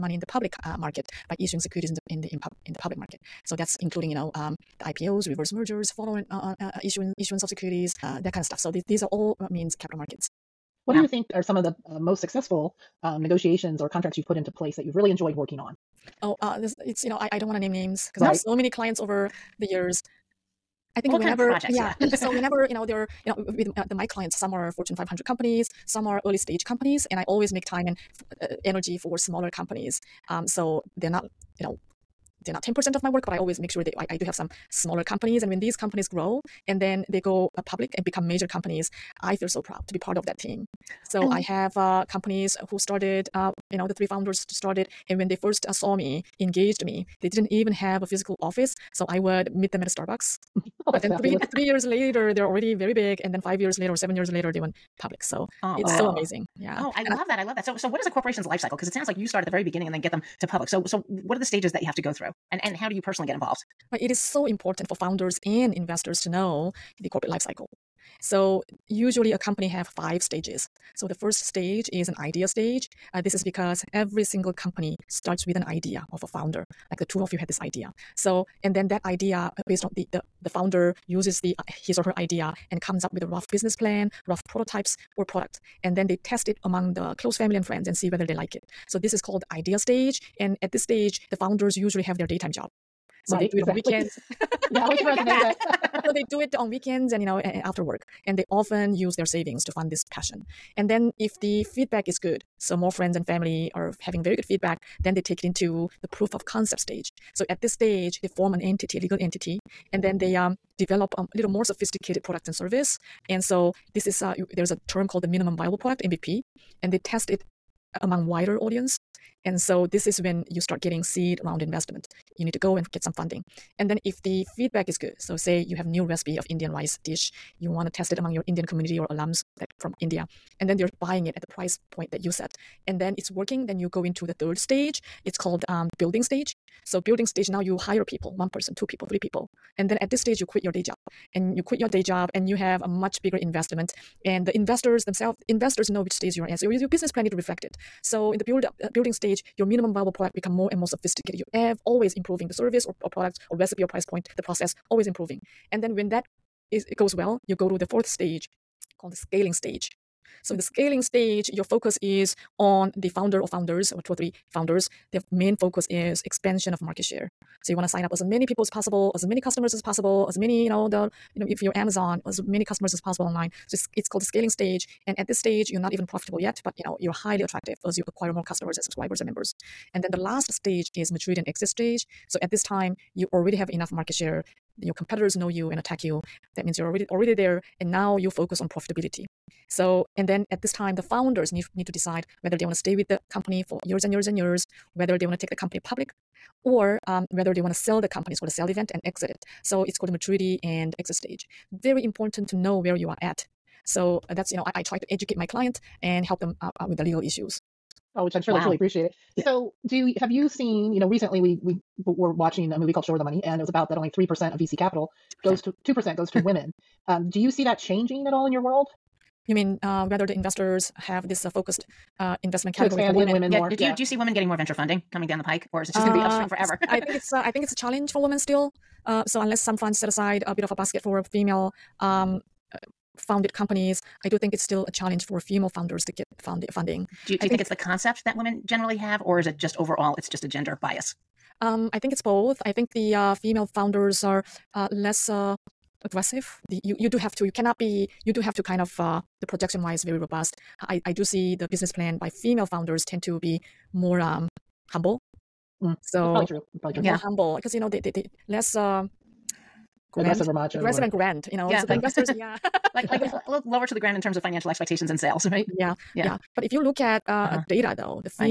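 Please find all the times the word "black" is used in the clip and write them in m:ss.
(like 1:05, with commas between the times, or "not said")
not said.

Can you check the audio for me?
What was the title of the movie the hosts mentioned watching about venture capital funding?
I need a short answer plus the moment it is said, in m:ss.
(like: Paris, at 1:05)
Show Her the Money, at 3:33.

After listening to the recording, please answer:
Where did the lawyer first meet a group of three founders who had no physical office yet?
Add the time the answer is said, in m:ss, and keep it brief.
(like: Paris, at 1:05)
Starbucks, at 0:49.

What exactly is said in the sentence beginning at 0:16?
oh uh this it's you know i i don't want to name names because right.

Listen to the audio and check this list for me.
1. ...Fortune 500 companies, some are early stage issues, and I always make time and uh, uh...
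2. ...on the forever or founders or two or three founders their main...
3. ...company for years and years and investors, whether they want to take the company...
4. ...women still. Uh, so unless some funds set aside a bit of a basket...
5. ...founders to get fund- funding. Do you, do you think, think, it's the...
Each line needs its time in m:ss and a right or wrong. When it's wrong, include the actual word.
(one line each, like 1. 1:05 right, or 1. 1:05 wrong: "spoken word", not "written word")
1. 0:24 wrong: "companies", not "issues"
2. 2:42 wrong: "founder", not "forever"
3. 3:13 wrong: "years", not "investors"
4. 3:48 right
5. 3:55 right.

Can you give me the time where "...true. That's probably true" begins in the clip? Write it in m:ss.
4:16.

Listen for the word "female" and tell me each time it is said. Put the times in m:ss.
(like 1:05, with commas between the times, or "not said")
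3:51, 4:03, 4:12.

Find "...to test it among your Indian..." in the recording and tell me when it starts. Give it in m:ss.
2:07.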